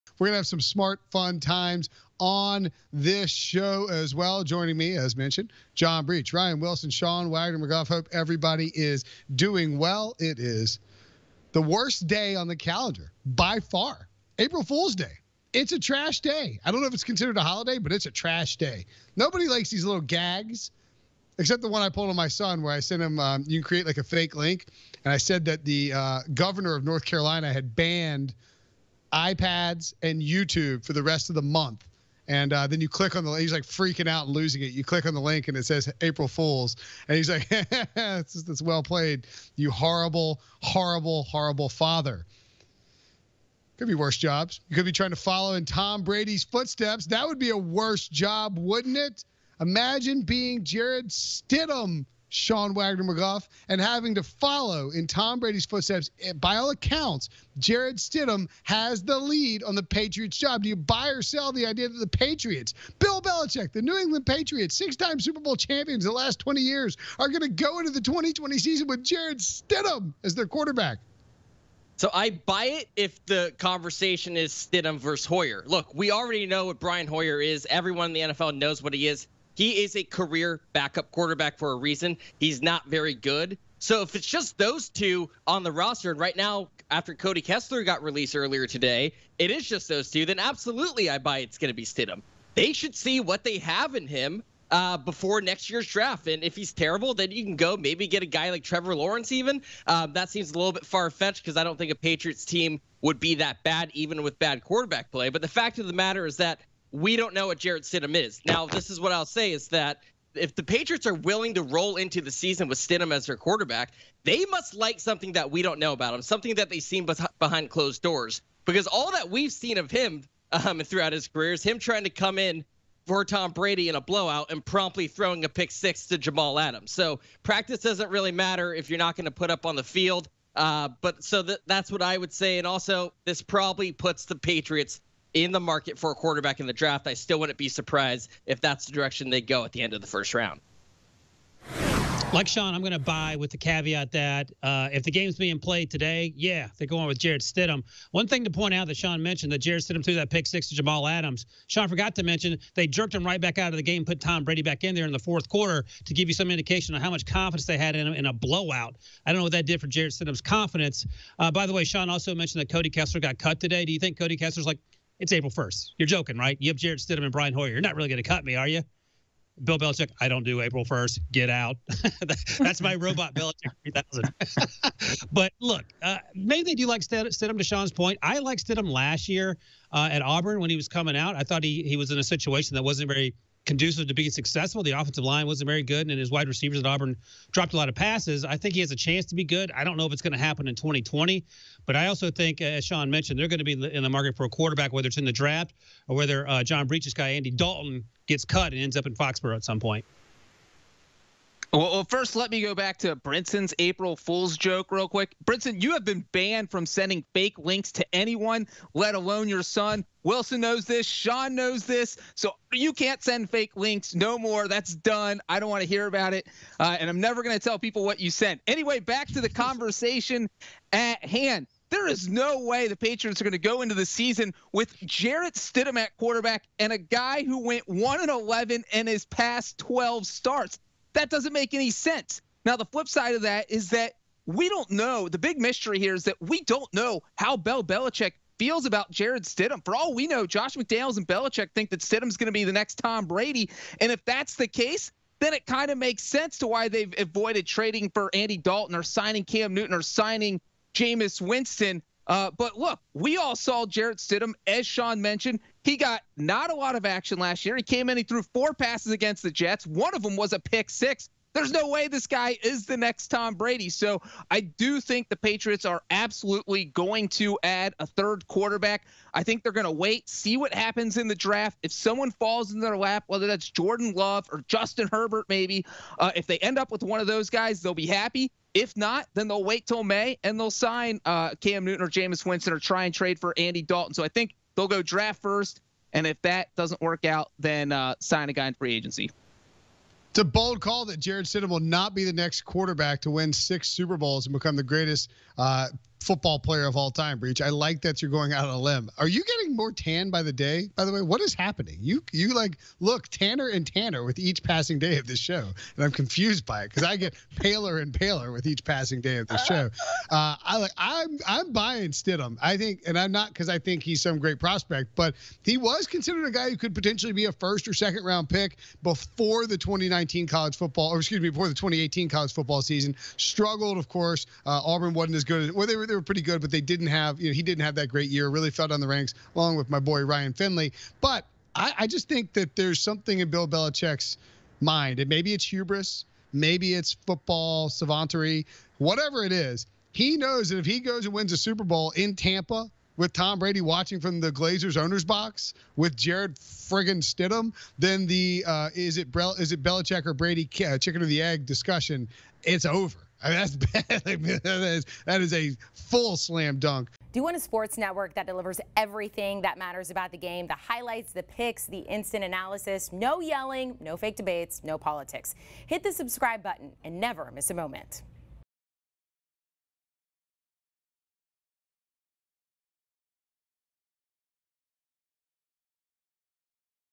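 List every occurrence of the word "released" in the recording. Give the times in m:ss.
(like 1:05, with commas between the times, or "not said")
1:28.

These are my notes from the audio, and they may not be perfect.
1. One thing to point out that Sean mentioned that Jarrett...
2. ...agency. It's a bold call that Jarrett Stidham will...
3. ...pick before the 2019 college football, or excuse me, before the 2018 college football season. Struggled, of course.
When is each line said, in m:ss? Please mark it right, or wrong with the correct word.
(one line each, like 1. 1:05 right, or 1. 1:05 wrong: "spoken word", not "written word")
1. 2:28 right
2. 4:48 right
3. 5:18 right.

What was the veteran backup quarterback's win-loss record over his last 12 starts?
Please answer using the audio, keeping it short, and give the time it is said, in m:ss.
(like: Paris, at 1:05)
1 and 11, at 3:47.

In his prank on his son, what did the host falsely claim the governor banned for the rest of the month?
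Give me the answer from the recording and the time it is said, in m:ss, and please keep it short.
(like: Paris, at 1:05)
iPads, at 0:29.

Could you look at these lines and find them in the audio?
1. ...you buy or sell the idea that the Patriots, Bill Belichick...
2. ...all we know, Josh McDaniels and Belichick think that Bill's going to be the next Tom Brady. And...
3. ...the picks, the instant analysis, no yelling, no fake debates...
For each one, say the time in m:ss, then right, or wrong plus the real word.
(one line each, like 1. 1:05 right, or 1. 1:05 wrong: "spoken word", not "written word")
1. 1:00 right
2. 3:59 wrong: "Stidham", not "Bill"
3. 6:01 right.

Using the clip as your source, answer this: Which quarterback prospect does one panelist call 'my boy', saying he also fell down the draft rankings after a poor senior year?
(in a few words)
Ryan Finley.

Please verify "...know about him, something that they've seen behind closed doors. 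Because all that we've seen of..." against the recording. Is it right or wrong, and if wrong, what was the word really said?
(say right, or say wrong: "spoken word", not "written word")
right.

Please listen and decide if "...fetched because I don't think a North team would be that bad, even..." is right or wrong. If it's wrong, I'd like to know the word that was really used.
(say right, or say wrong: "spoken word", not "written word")
wrong: "Patriots", not "North".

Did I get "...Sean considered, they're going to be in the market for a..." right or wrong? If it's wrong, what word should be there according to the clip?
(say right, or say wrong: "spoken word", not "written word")
wrong: "mentioned", not "considered".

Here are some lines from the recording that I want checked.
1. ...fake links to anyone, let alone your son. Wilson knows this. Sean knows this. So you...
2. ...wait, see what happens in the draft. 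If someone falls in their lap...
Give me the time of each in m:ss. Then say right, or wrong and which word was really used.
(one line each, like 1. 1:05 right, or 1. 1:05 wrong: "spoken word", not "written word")
1. 3:27 right
2. 4:29 right.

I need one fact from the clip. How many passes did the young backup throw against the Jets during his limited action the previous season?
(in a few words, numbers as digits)
four.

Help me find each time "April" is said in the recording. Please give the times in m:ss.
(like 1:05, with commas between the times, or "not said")
0:14, 0:36, 2:45, 2:50, 3:23.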